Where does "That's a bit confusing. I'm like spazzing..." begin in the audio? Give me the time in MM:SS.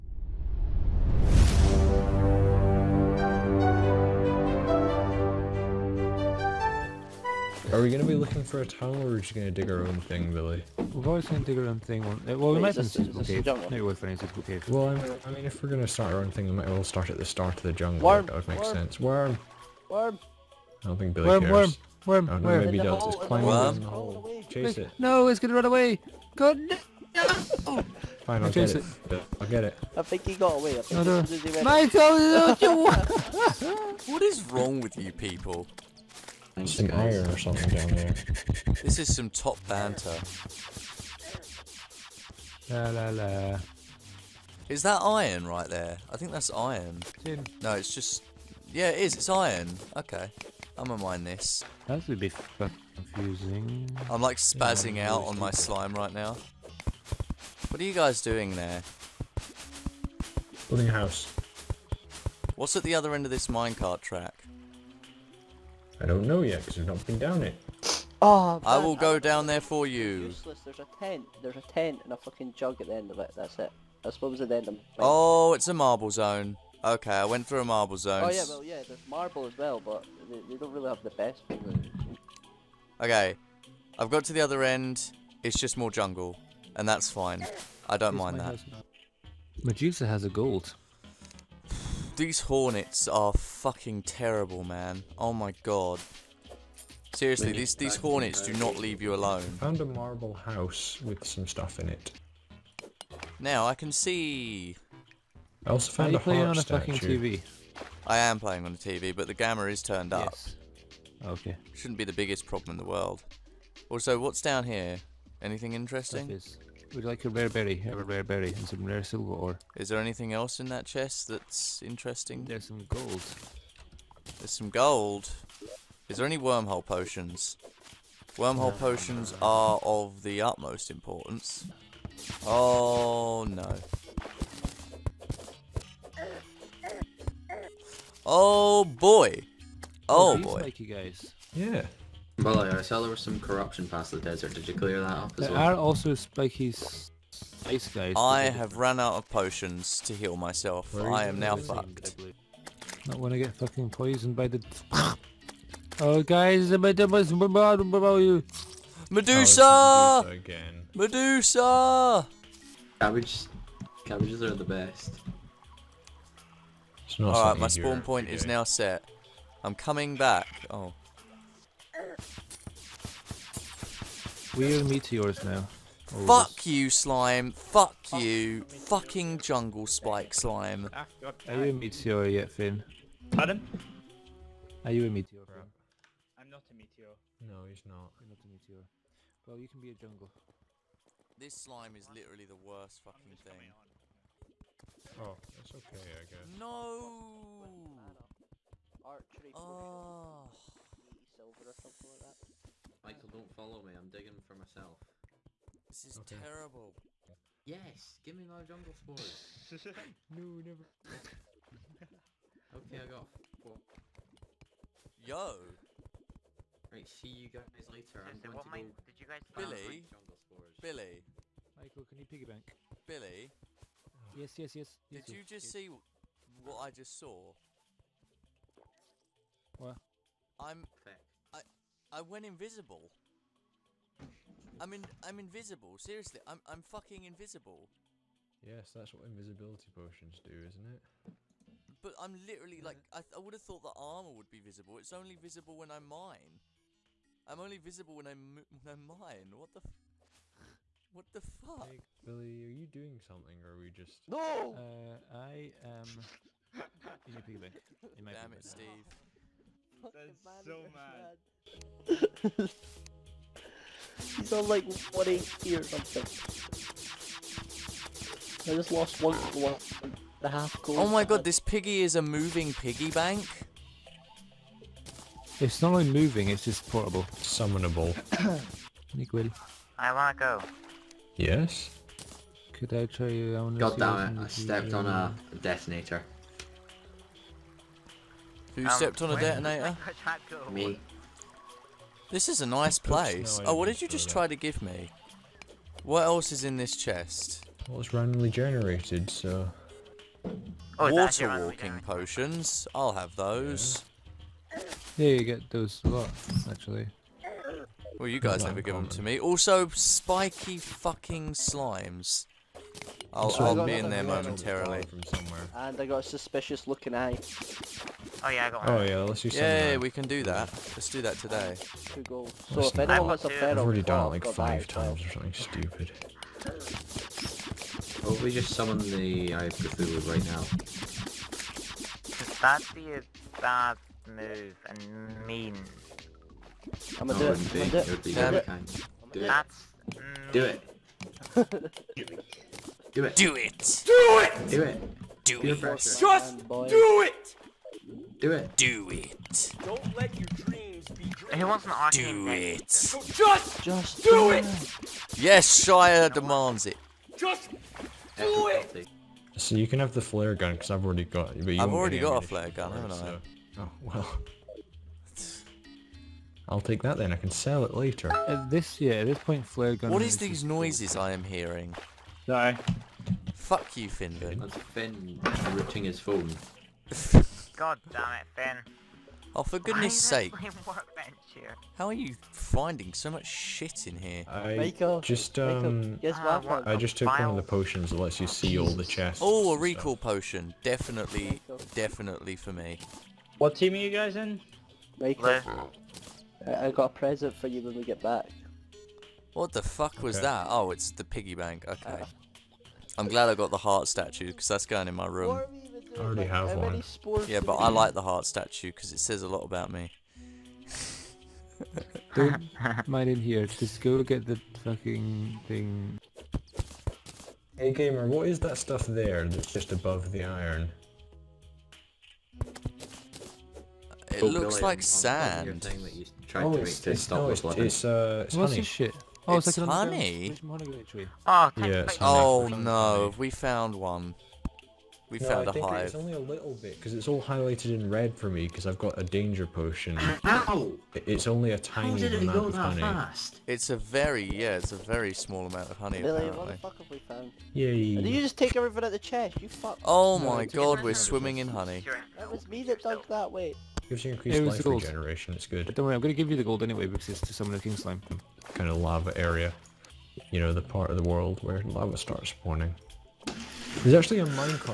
00:51.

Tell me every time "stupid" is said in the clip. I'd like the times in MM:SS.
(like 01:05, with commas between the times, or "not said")
05:25.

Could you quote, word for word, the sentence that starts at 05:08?
Well, you guys never give them to me.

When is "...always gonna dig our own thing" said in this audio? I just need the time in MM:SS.
00:11.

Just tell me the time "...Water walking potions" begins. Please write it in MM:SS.
05:01.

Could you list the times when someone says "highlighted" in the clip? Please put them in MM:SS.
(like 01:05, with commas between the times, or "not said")
07:17.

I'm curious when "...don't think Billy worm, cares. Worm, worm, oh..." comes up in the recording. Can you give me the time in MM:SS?
00:20.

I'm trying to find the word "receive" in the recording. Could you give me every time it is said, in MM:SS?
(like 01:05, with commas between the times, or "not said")
not said.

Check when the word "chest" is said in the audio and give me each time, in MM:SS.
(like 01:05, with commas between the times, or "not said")
02:00, 04:56, 06:29, 07:29.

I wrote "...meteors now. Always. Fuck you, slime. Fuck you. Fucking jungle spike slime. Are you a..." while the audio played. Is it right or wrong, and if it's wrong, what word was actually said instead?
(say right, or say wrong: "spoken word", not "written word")
right.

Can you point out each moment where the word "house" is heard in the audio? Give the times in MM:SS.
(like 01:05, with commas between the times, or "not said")
01:00, 01:40.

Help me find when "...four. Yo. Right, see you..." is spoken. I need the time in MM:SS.
03:33.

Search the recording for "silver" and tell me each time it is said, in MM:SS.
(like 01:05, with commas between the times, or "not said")
01:59, 03:21.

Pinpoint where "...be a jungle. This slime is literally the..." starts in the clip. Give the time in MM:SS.
03:09.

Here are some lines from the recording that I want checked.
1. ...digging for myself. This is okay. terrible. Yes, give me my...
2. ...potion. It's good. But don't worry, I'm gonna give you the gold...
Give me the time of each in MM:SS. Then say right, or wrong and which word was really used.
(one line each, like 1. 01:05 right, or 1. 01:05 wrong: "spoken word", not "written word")
1. 03:24 right
2. 07:34 wrong: "regeneration", not "potion".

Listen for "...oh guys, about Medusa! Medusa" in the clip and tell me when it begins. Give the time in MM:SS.
02:35.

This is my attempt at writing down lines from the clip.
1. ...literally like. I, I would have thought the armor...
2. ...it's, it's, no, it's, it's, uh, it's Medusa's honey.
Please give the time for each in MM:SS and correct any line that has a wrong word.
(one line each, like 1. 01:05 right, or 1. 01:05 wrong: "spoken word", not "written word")
1. 04:02 right
2. 07:06 wrong: "What", not "Medusa".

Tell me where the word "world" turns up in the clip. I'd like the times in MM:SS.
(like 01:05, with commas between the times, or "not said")
01:52, 07:41.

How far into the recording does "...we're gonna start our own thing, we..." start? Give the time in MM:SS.
00:15.